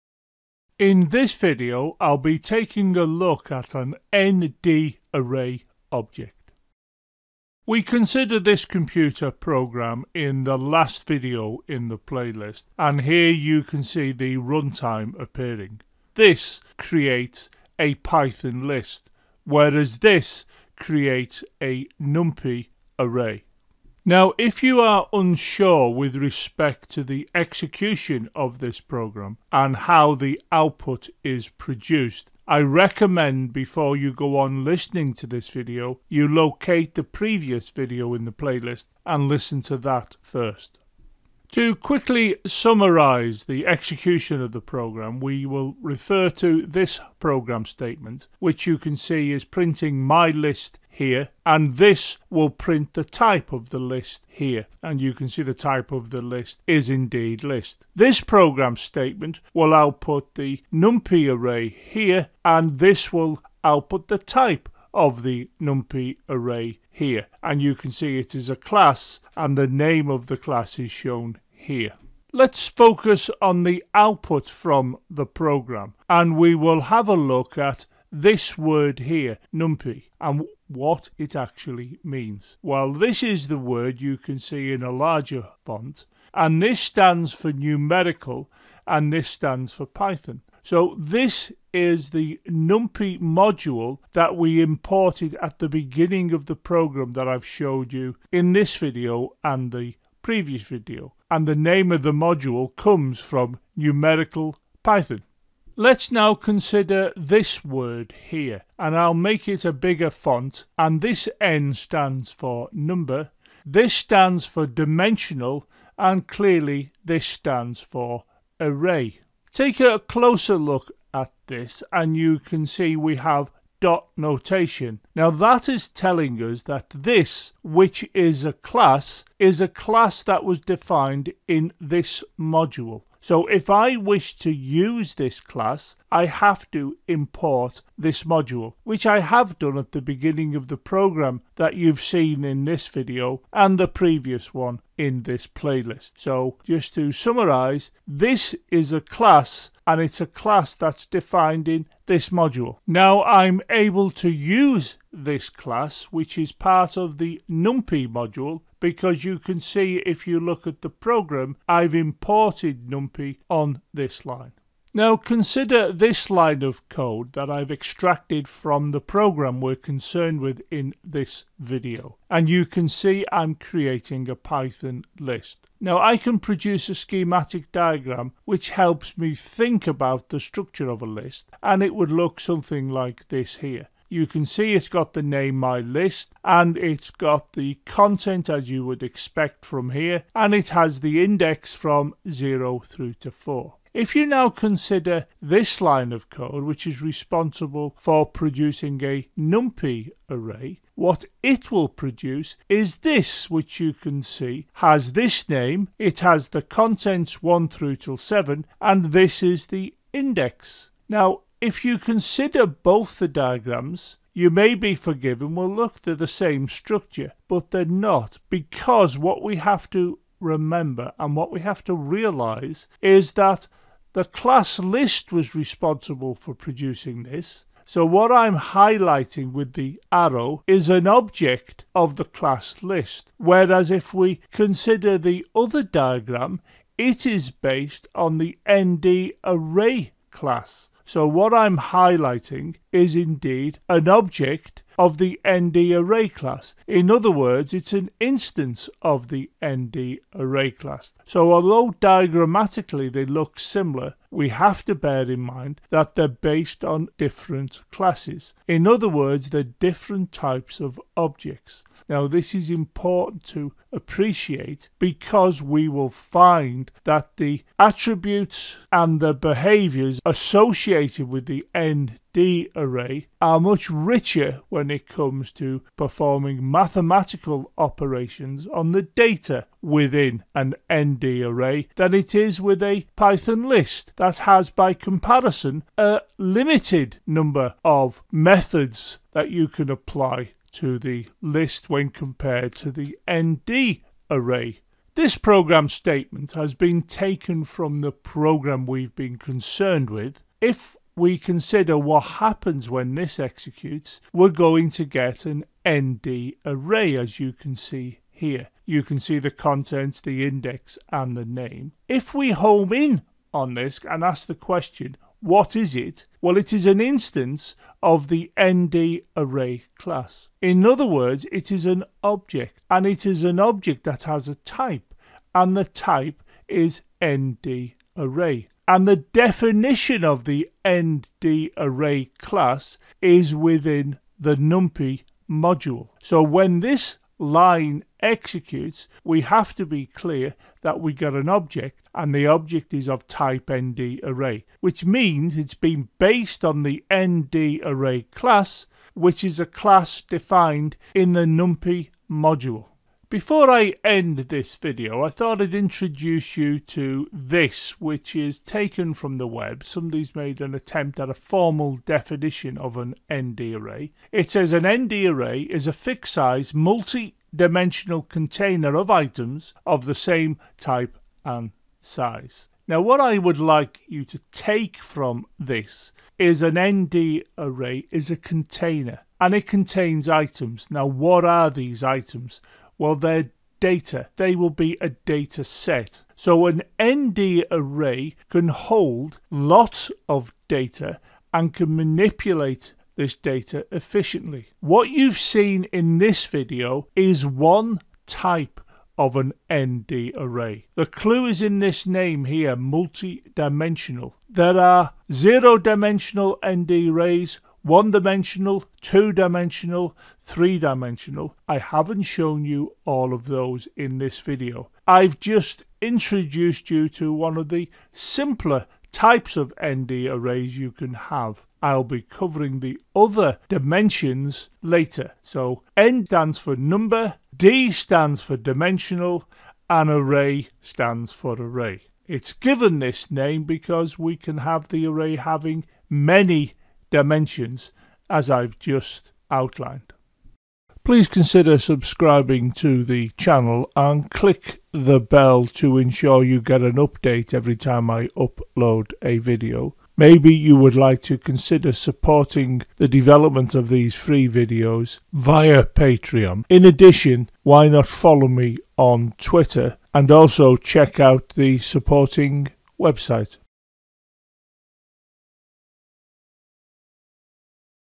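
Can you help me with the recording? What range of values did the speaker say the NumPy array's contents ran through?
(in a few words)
1 through 7.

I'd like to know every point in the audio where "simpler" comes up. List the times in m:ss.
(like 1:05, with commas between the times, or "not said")
6:58.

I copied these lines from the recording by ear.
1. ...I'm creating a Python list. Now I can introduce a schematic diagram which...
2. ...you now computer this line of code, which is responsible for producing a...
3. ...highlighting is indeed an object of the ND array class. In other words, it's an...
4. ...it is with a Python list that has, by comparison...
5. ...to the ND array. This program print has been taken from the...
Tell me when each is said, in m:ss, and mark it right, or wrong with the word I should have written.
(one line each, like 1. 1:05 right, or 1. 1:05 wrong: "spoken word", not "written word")
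1. 2:53 wrong: "produce", not "introduce"
2. 3:14 wrong: "consider", not "computer"
3. 4:01 right
4. 4:42 right
5. 4:52 wrong: "statement", not "print".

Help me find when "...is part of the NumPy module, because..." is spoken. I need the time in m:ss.
2:36.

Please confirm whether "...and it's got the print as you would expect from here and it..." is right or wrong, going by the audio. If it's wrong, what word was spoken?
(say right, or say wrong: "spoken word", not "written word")
wrong: "content", not "print".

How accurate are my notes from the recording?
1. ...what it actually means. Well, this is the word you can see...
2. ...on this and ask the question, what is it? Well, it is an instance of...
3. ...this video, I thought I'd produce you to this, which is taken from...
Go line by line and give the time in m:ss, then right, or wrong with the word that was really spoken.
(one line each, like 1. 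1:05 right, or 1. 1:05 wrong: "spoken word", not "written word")
1. 1:20 right
2. 5:13 right
3. 5:54 wrong: "introduce", not "produce".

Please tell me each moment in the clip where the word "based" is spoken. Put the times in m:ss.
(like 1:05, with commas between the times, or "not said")
3:57, 4:16, 5:46.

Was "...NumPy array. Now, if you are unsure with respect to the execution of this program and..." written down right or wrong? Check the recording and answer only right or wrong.
right.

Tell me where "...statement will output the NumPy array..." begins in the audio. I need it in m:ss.
0:58.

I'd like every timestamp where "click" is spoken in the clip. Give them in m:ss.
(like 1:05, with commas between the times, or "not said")
7:24.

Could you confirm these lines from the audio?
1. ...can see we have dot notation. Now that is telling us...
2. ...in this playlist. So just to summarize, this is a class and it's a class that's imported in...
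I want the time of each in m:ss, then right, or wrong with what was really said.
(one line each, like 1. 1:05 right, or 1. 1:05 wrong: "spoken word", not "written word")
1. 2:02 right
2. 2:24 wrong: "defined", not "imported".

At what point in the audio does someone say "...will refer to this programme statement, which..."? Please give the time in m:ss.
0:45.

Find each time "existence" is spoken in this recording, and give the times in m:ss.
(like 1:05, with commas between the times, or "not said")
not said.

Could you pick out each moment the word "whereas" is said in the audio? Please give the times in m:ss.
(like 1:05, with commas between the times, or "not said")
0:19, 3:53.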